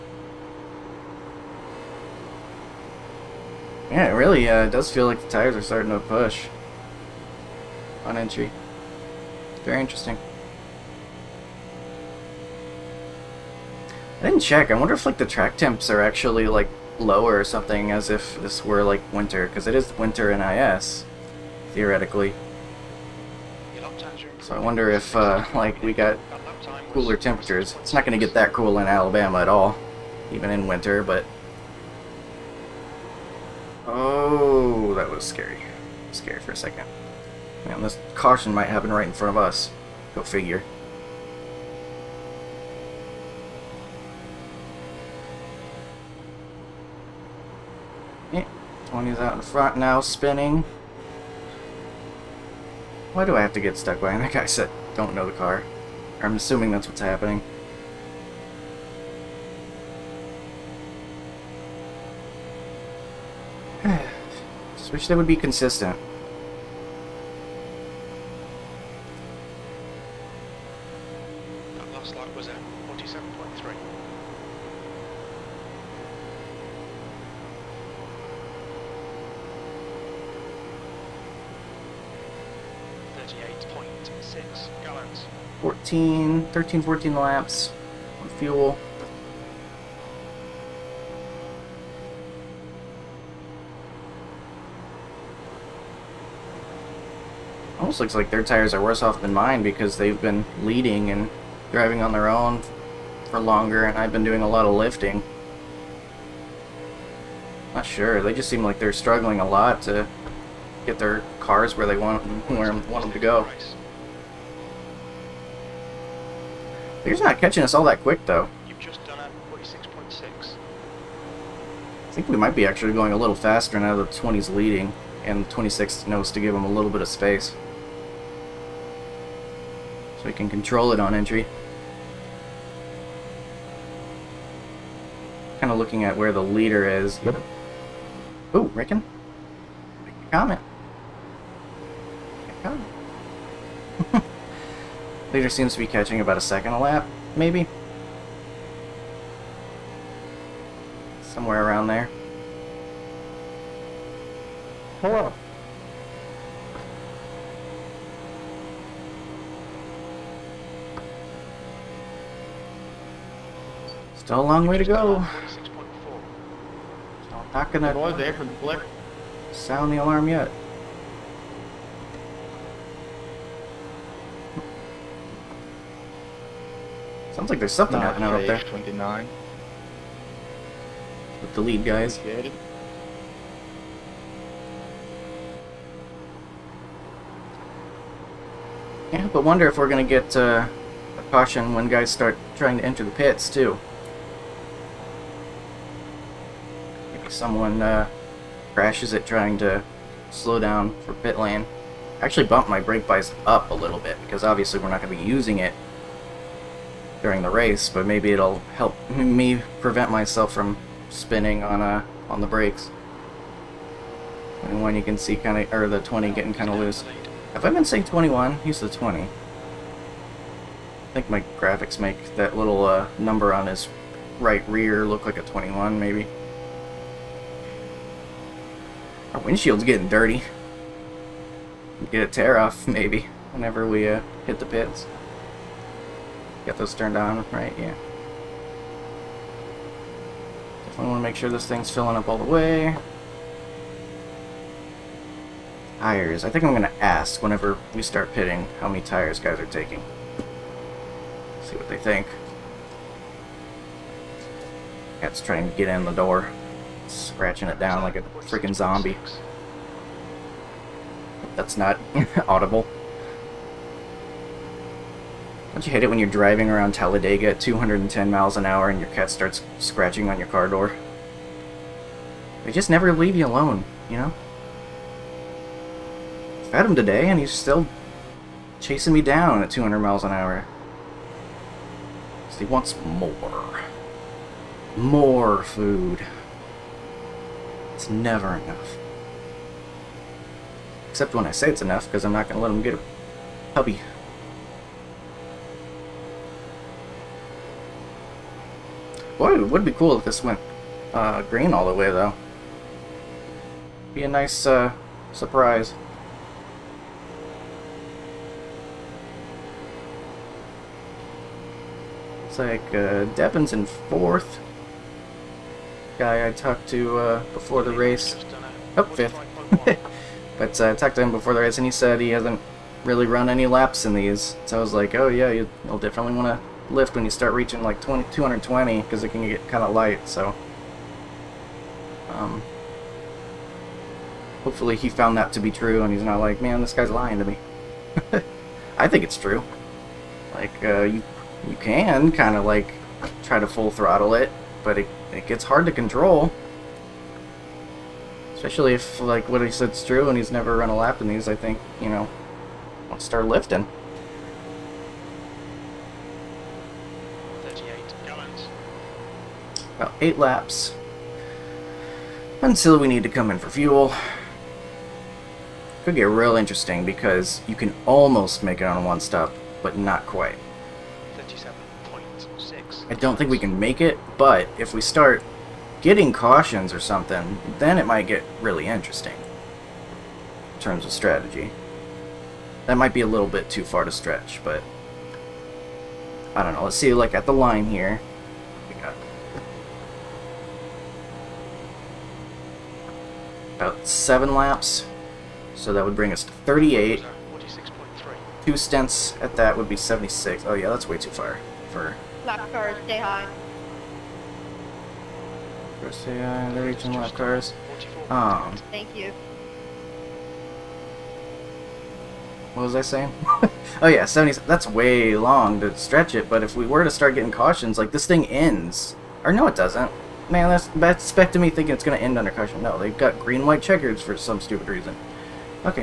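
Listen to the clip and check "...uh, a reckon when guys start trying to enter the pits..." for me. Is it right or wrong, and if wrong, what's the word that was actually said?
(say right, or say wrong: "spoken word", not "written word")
wrong: "caution", not "reckon".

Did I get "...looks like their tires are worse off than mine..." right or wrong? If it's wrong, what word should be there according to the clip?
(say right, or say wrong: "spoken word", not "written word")
right.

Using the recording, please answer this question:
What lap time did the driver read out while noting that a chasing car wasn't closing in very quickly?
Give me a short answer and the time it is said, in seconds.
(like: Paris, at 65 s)
46.6, at 119 s.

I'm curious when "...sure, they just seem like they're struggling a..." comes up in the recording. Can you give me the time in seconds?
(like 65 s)
107 s.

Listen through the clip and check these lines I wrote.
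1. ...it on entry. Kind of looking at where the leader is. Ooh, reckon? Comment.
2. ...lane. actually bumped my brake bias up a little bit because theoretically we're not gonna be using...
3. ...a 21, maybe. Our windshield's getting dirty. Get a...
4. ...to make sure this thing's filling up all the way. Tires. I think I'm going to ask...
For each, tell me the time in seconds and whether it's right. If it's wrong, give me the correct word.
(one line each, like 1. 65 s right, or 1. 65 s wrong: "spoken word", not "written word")
1. 130 s right
2. 201 s wrong: "obviously", not "theoretically"
3. 225 s right
4. 241 s right.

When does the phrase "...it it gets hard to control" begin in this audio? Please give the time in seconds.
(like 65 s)
344 s.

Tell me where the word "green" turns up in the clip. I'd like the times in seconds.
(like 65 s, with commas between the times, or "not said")
301 s, 423 s.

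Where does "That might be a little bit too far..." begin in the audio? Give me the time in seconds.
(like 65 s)
382 s.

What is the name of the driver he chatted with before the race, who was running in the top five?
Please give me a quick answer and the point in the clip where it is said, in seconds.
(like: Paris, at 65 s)
Devin, at 313 s.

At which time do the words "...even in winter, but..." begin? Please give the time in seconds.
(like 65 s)
30 s.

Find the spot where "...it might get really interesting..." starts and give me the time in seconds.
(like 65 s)
377 s.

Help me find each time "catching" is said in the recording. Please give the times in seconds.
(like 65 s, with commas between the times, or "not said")
117 s, 145 s.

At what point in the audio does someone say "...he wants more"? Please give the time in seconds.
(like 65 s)
282 s.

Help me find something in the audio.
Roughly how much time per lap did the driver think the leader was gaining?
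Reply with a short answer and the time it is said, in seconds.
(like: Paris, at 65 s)
about a second, at 146 s.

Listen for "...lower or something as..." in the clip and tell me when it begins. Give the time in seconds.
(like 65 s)
17 s.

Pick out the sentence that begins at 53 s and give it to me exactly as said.
Why do I have to get stuck behind that guy?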